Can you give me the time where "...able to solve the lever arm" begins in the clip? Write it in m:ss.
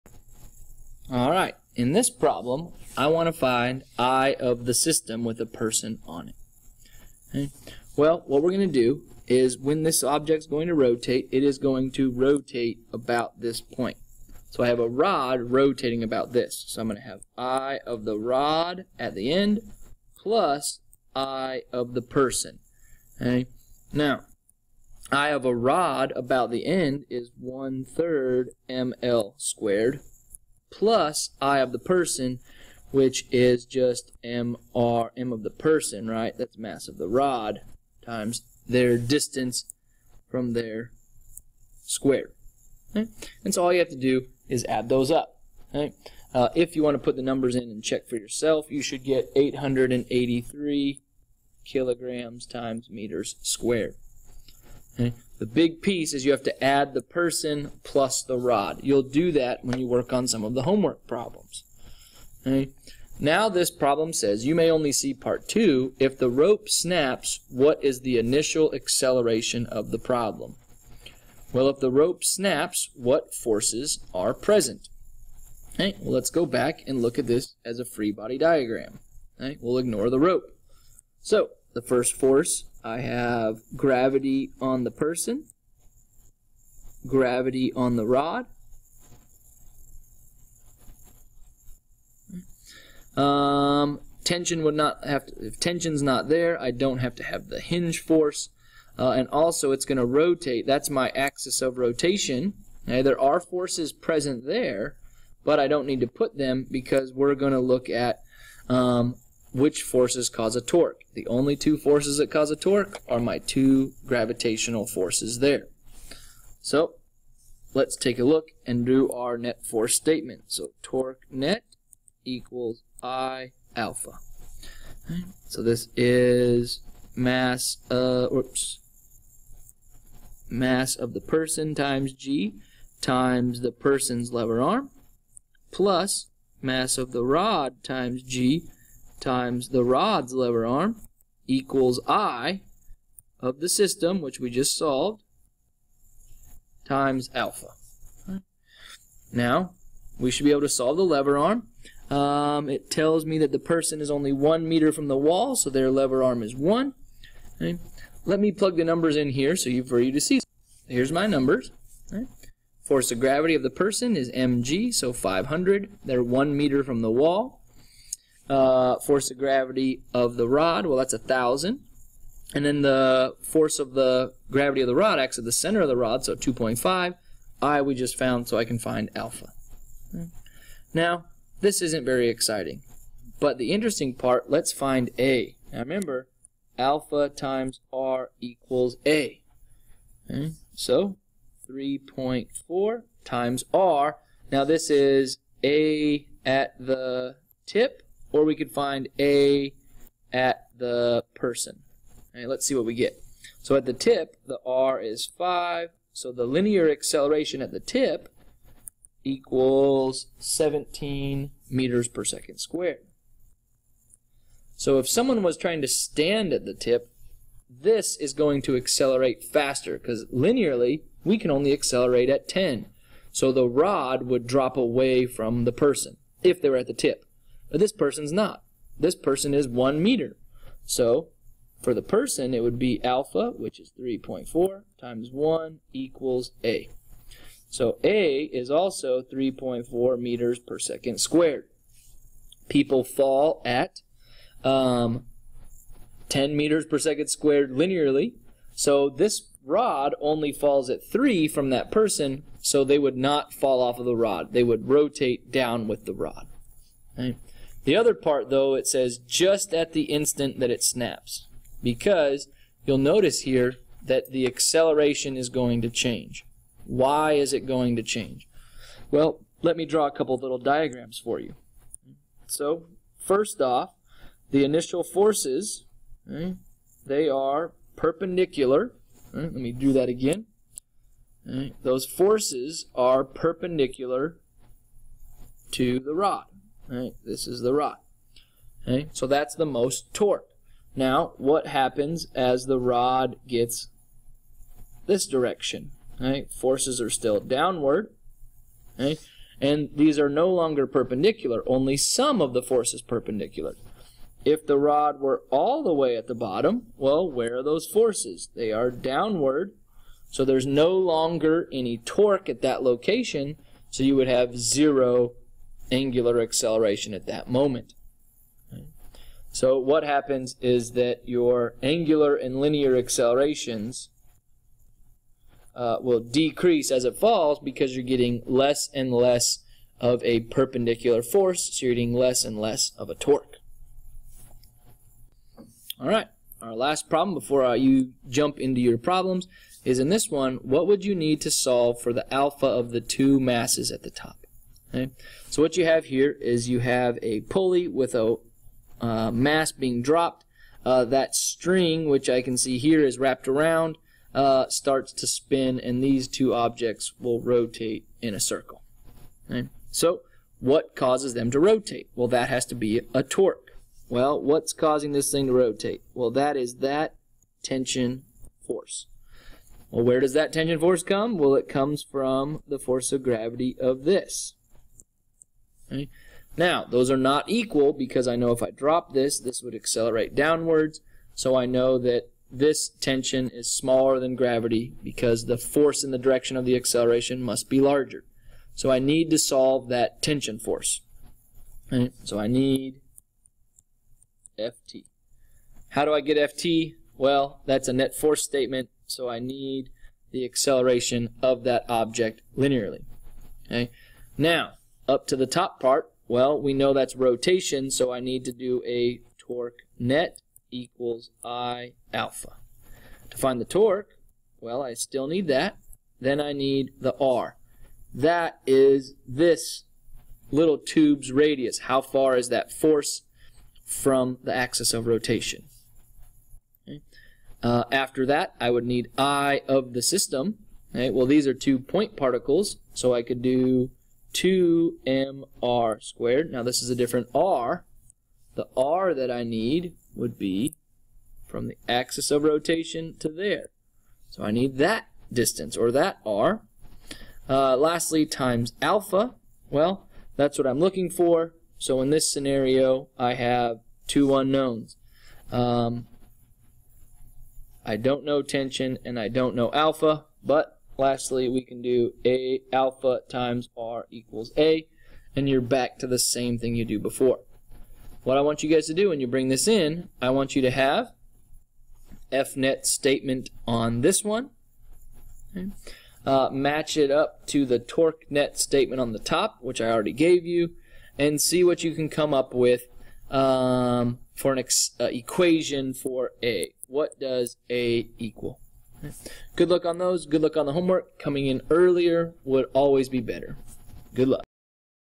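2:30.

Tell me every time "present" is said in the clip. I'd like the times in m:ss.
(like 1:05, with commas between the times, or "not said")
1:14, 1:43.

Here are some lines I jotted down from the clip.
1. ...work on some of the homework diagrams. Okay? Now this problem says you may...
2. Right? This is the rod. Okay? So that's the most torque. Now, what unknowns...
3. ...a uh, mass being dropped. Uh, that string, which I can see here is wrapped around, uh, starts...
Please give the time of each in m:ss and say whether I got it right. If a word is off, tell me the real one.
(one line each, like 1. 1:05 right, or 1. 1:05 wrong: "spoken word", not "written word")
1. 0:59 wrong: "problems", not "diagrams"
2. 4:46 wrong: "happens", not "unknowns"
3. 5:48 right.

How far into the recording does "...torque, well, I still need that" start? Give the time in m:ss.
6:53.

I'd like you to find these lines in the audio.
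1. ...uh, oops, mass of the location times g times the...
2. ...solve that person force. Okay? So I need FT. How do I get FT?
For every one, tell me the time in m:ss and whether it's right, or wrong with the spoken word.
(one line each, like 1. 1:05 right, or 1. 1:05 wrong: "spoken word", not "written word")
1. 2:07 wrong: "person", not "location"
2. 6:29 wrong: "tension", not "person".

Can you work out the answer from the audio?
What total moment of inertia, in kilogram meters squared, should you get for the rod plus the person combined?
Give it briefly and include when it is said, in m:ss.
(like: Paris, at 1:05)
883, at 0:49.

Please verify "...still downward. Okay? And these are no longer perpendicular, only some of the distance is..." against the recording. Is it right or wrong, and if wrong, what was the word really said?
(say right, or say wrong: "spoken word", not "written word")
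wrong: "force", not "distance".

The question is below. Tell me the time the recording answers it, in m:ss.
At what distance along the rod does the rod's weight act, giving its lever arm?
2:56.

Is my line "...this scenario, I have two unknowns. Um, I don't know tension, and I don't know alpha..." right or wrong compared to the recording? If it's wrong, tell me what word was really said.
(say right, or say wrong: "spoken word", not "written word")
right.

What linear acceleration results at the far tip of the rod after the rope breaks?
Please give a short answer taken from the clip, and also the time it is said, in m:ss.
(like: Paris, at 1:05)
17 meters per second squared, at 3:30.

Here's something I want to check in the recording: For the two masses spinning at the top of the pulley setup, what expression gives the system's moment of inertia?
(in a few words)
2mr squared.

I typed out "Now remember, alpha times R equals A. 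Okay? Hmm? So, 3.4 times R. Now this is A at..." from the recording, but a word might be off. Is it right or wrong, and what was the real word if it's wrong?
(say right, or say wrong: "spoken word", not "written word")
right.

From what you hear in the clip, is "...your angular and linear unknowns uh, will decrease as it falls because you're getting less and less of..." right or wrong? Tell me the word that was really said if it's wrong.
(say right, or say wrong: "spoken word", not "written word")
wrong: "accelerations", not "unknowns".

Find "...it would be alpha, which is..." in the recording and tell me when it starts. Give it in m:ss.
3:52.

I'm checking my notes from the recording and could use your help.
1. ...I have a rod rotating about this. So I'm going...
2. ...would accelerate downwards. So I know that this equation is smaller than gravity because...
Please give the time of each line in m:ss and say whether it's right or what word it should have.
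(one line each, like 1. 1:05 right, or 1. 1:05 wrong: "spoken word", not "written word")
1. 0:14 right
2. 6:19 wrong: "tension", not "equation".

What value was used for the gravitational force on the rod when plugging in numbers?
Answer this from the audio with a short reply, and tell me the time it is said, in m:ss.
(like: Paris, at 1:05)
1,000, at 2:51.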